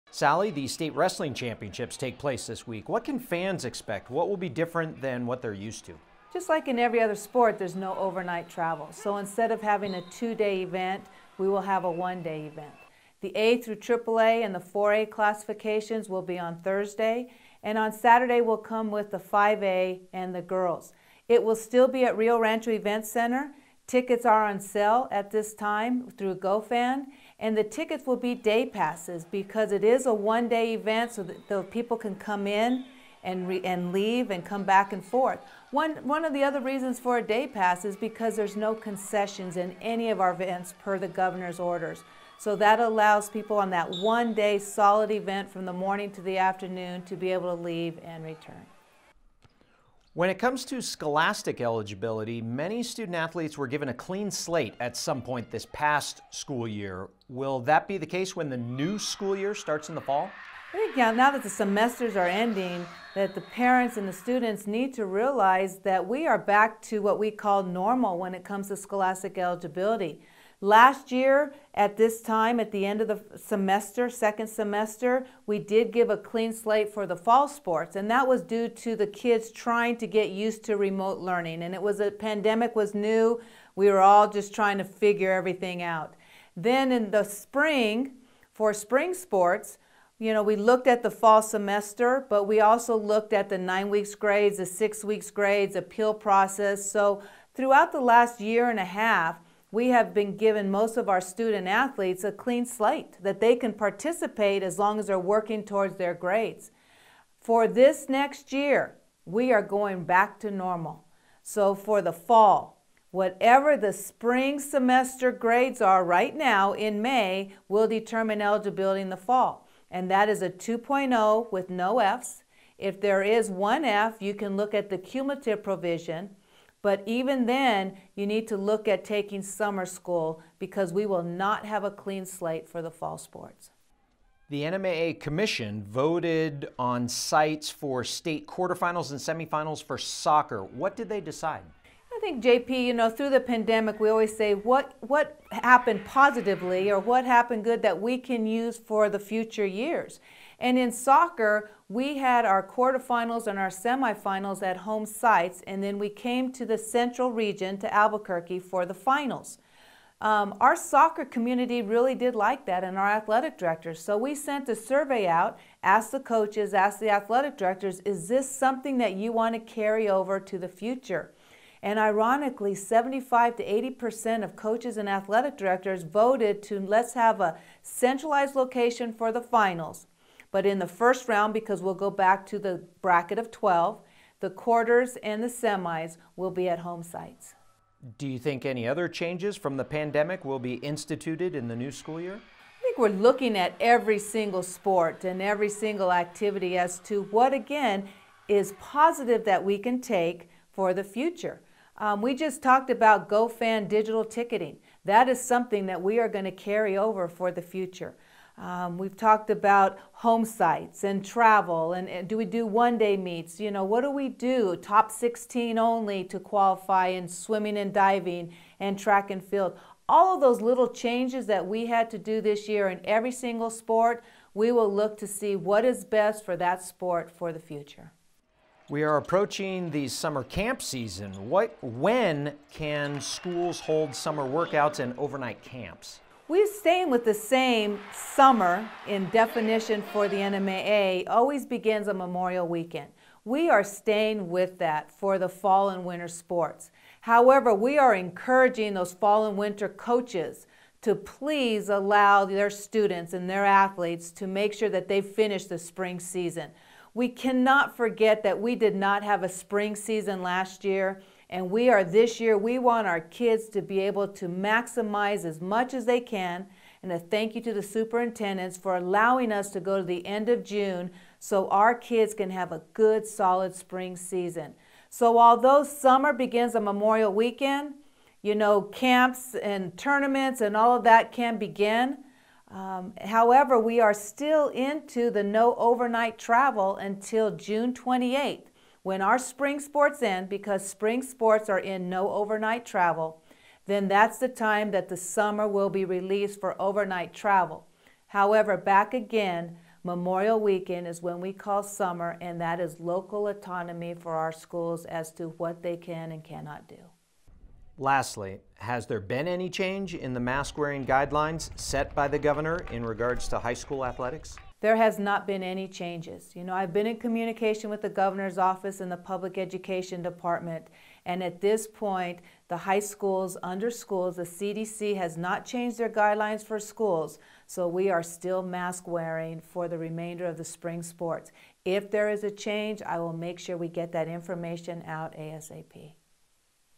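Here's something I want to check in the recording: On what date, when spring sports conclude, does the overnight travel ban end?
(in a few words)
June 28.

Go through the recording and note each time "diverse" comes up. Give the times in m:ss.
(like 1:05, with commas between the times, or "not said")
not said.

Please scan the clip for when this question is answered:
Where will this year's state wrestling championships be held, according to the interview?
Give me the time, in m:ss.
0:22.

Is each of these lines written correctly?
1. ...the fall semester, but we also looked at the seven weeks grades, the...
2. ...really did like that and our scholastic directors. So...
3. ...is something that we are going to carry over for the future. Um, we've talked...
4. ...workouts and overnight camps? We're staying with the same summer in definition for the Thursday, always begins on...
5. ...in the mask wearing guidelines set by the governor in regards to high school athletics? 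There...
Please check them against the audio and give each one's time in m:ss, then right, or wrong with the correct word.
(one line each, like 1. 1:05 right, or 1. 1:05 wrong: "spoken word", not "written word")
1. 1:31 wrong: "nine", not "seven"
2. 2:41 wrong: "athletic", not "scholastic"
3. 3:25 right
4. 3:54 wrong: "NMAA", not "Thursday"
5. 5:10 right.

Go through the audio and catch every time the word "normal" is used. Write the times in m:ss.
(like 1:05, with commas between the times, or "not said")
1:07, 1:50.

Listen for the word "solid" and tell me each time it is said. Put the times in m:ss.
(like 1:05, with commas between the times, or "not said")
0:44, 4:33.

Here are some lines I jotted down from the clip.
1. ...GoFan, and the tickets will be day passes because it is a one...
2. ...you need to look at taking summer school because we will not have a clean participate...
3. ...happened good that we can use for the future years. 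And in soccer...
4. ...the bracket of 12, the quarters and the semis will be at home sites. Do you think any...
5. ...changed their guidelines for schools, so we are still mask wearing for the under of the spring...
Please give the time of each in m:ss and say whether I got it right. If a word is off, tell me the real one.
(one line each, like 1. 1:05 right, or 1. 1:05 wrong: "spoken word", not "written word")
1. 0:26 right
2. 2:08 wrong: "slate", not "participate"
3. 2:27 right
4. 3:02 right
5. 5:25 wrong: "remainder", not "under".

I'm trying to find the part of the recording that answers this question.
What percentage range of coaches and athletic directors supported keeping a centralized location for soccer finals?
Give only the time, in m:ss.
2:52.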